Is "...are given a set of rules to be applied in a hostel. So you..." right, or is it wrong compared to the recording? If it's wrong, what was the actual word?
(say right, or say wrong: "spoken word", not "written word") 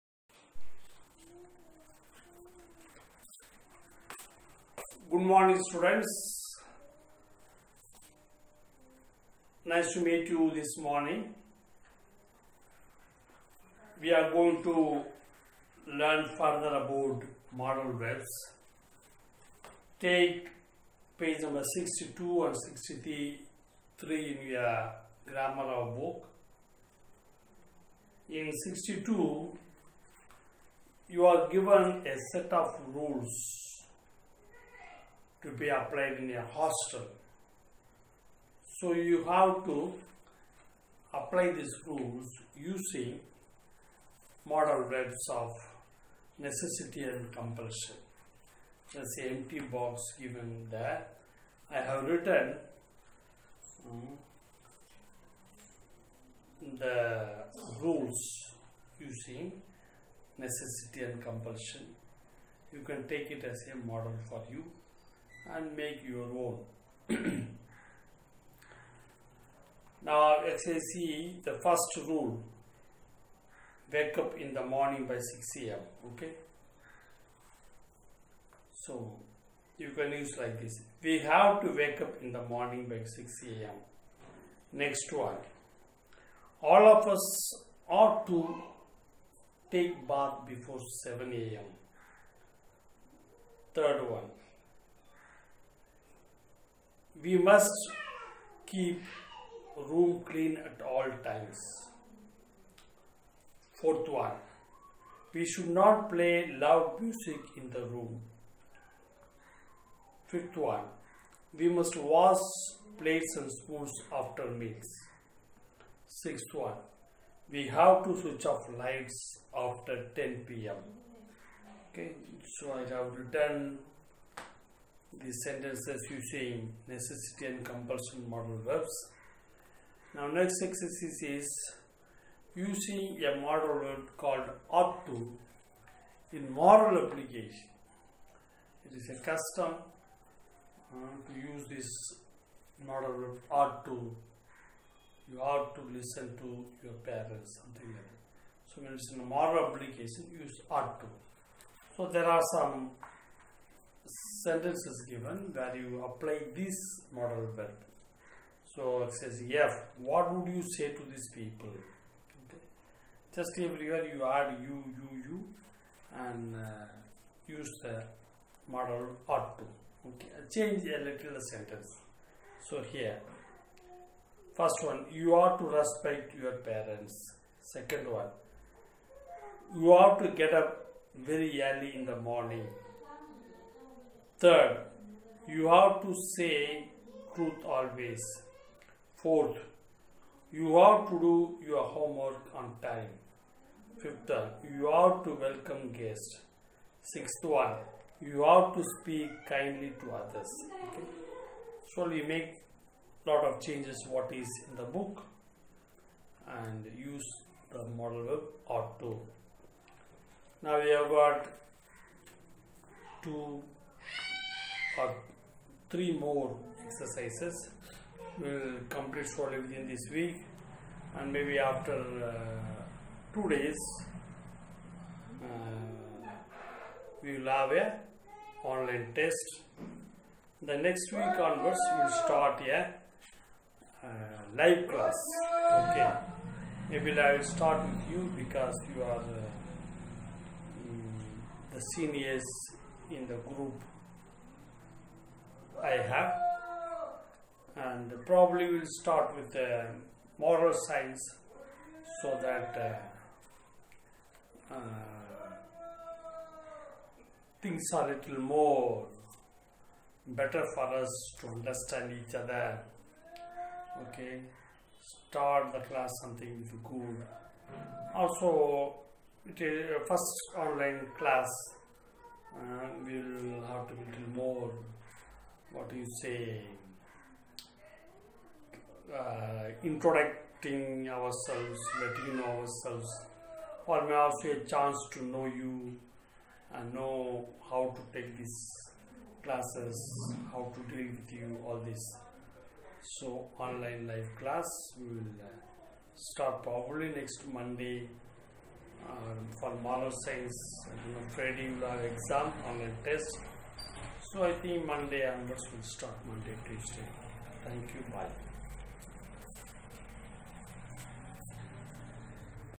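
right.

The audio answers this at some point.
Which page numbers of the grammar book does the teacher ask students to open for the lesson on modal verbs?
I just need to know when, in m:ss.
0:21.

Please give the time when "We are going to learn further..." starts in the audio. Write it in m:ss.
0:14.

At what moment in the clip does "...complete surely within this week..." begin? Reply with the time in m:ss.
3:38.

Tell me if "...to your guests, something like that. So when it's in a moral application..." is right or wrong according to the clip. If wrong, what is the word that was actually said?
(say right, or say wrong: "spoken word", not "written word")
wrong: "parents", not "guests".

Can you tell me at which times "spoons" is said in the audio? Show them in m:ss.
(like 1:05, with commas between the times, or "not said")
1:53.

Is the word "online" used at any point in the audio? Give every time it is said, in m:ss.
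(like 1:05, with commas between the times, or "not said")
3:48, 4:30, 4:53, 5:02.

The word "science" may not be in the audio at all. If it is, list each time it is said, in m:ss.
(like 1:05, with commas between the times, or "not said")
4:10, 5:00.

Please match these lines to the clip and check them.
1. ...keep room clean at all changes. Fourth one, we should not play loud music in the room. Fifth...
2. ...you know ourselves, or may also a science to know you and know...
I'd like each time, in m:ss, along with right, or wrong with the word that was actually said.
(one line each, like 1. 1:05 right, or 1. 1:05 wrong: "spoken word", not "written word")
1. 1:38 wrong: "times", not "changes"
2. 4:42 wrong: "chance", not "science".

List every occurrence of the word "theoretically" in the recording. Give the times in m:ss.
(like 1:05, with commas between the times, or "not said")
not said.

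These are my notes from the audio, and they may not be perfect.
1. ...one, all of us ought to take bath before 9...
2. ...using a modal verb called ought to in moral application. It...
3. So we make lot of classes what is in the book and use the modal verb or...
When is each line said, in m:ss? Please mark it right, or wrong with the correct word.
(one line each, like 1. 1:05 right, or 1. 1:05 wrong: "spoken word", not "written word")
1. 1:25 wrong: "7", not "9"
2. 2:12 right
3. 3:21 wrong: "changes", not "classes".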